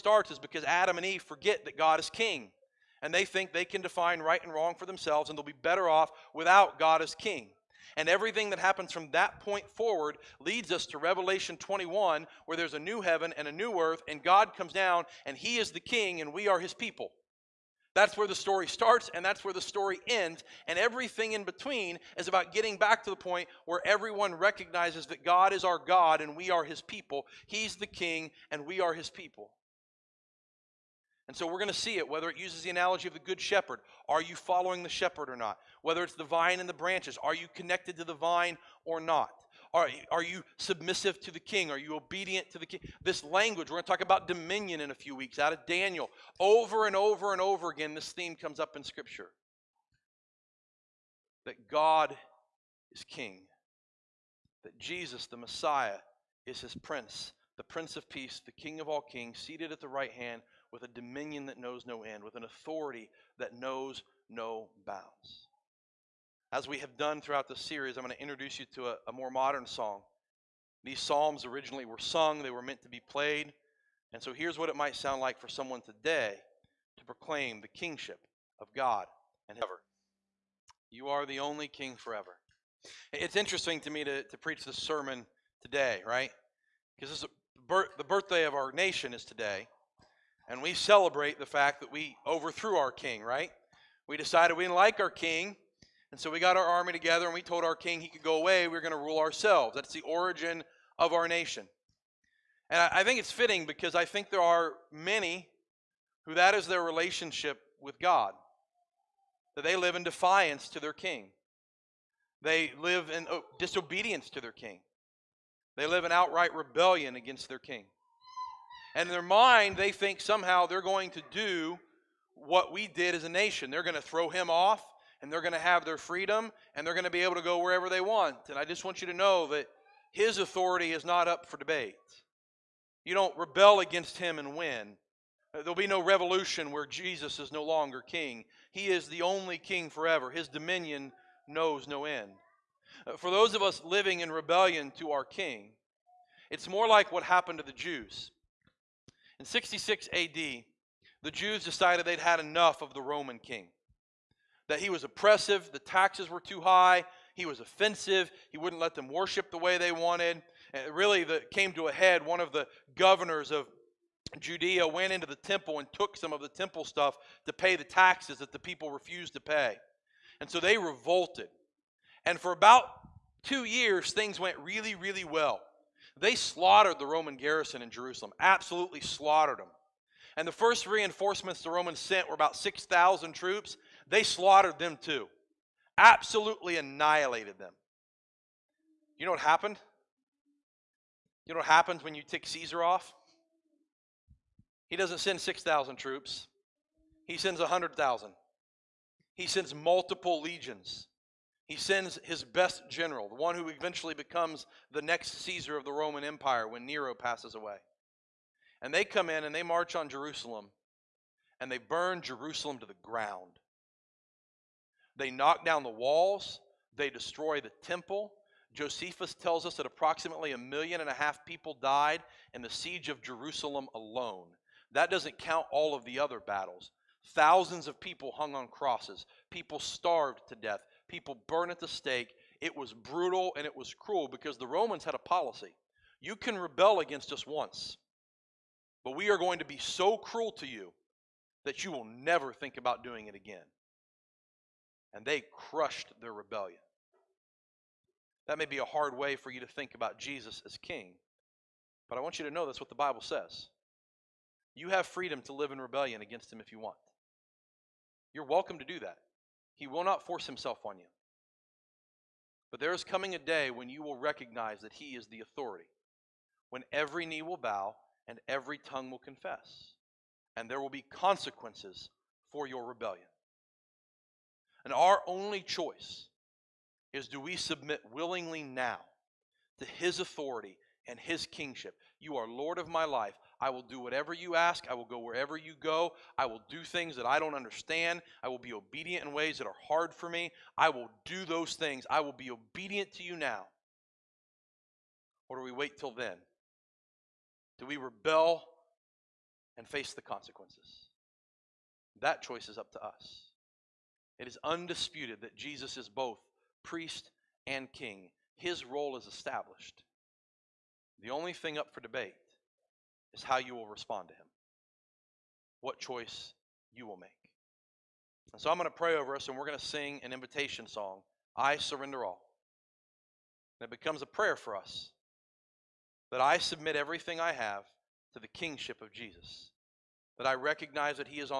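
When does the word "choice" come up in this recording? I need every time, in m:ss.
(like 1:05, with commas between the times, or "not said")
4:35, 5:02, 5:15.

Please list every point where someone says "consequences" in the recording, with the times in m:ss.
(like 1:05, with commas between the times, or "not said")
4:31, 5:00.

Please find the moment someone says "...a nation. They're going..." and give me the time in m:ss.
2:03.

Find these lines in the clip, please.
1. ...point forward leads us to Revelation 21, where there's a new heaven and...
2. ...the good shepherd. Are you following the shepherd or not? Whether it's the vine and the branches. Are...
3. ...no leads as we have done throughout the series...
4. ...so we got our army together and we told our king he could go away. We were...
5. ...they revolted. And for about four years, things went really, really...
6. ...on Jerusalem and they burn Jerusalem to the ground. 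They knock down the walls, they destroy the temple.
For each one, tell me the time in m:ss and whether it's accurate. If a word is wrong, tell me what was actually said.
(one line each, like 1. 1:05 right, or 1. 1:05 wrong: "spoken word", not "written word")
1. 0:09 right
2. 0:33 right
3. 1:04 wrong: "bounds", not "leads"
4. 1:36 right
5. 2:50 wrong: "two", not "four"
6. 3:29 right.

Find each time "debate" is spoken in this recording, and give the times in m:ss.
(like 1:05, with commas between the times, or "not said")
2:11, 5:11.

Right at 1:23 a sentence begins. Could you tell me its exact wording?
It's interesting to me to, to preach this sermon today, right?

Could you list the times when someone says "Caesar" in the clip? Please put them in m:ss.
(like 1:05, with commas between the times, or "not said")
3:12, 3:25.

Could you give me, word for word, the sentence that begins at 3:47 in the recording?
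Thousands of people hung on crosses, people starved to death, people burned at the stake.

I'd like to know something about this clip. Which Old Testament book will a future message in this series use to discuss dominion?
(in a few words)
Daniel.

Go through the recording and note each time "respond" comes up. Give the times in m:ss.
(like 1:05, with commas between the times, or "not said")
5:13.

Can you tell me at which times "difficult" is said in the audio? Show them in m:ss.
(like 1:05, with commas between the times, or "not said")
not said.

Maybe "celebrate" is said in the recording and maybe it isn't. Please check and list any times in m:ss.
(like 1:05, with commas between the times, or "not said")
1:30.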